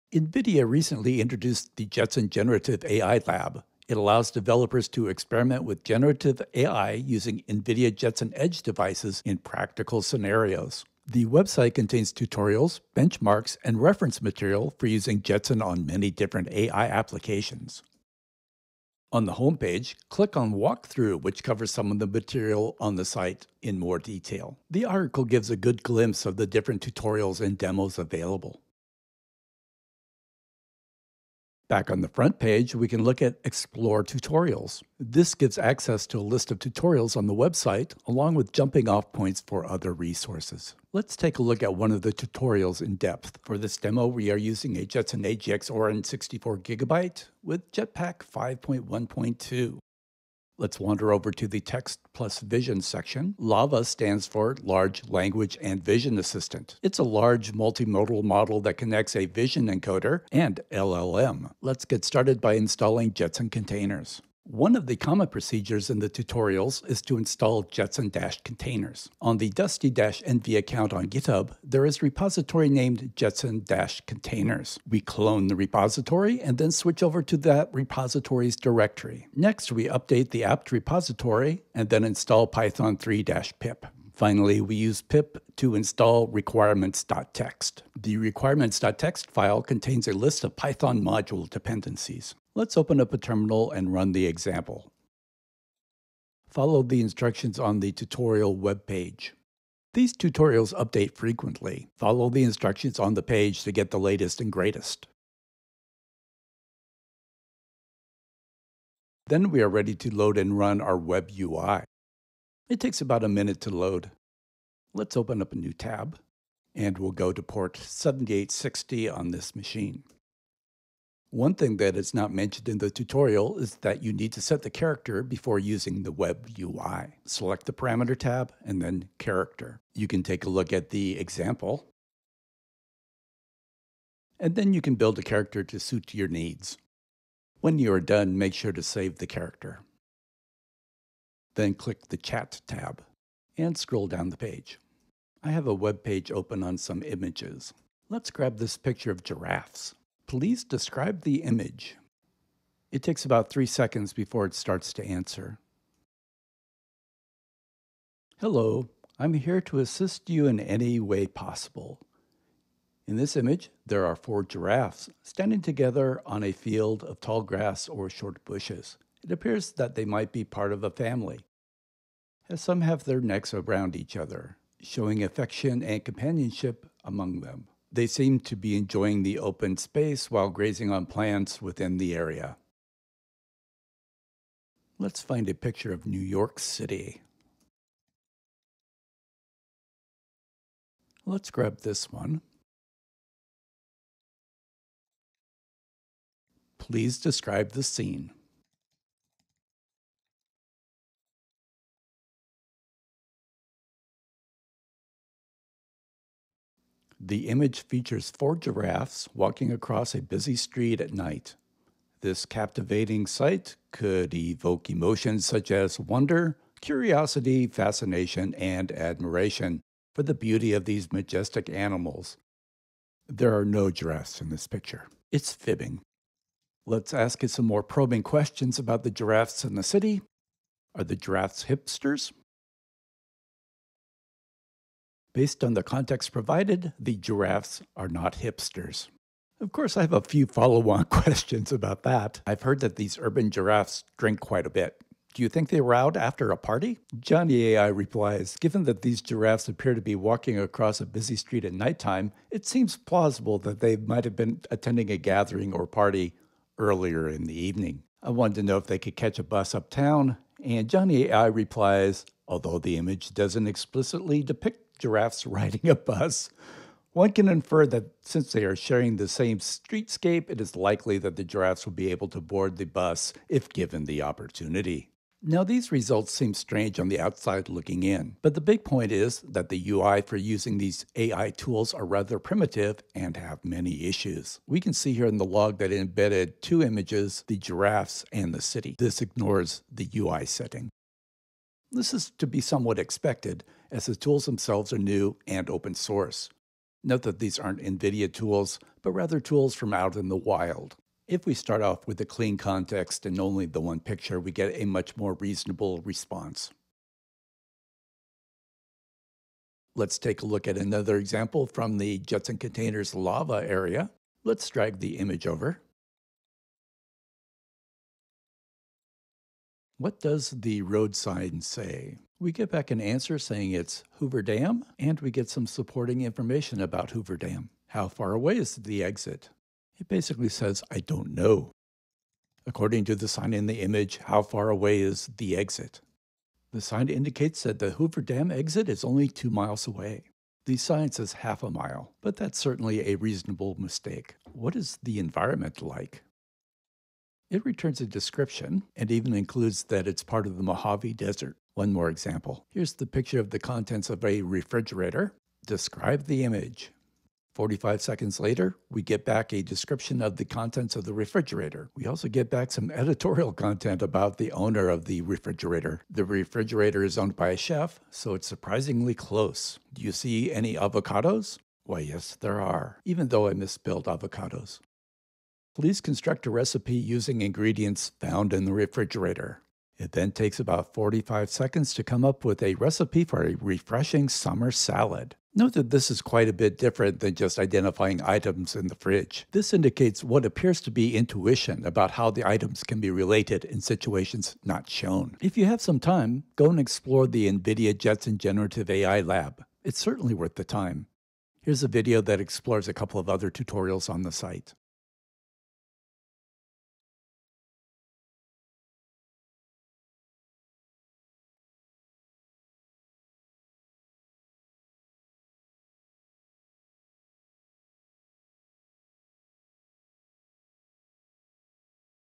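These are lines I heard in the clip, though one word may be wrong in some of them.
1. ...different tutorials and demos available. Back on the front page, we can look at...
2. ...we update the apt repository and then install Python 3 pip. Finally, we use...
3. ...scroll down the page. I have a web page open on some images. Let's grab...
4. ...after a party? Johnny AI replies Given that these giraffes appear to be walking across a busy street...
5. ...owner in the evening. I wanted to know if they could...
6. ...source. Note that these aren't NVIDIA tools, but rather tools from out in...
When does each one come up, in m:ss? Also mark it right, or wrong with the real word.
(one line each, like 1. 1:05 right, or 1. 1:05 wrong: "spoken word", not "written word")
1. 0:26 right
2. 1:19 right
3. 2:23 right
4. 4:06 right
5. 4:16 wrong: "earlier", not "owner"
6. 4:55 right.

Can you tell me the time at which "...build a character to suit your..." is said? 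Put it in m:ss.
2:14.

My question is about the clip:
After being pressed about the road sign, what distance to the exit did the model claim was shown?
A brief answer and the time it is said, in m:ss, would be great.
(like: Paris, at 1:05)
2 miles, at 5:39.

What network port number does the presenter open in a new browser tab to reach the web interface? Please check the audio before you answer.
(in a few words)
7860.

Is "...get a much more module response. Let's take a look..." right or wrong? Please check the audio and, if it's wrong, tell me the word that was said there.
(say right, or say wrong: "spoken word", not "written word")
wrong: "reasonable", not "module".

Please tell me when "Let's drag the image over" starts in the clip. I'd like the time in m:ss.
5:14.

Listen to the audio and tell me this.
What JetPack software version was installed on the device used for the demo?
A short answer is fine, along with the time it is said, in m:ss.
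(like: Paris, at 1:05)
5.1.2, at 0:48.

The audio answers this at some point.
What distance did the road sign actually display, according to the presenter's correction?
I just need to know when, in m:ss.
5:41.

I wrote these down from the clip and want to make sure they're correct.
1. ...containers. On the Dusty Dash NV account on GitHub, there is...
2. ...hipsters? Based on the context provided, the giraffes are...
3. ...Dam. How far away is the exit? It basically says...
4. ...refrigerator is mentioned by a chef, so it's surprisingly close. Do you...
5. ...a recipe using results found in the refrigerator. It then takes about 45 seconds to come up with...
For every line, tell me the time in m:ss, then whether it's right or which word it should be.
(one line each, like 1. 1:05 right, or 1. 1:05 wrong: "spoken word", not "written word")
1. 1:08 right
2. 3:51 right
3. 5:27 right
4. 6:06 wrong: "owned", not "mentioned"
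5. 6:16 wrong: "ingredients", not "results".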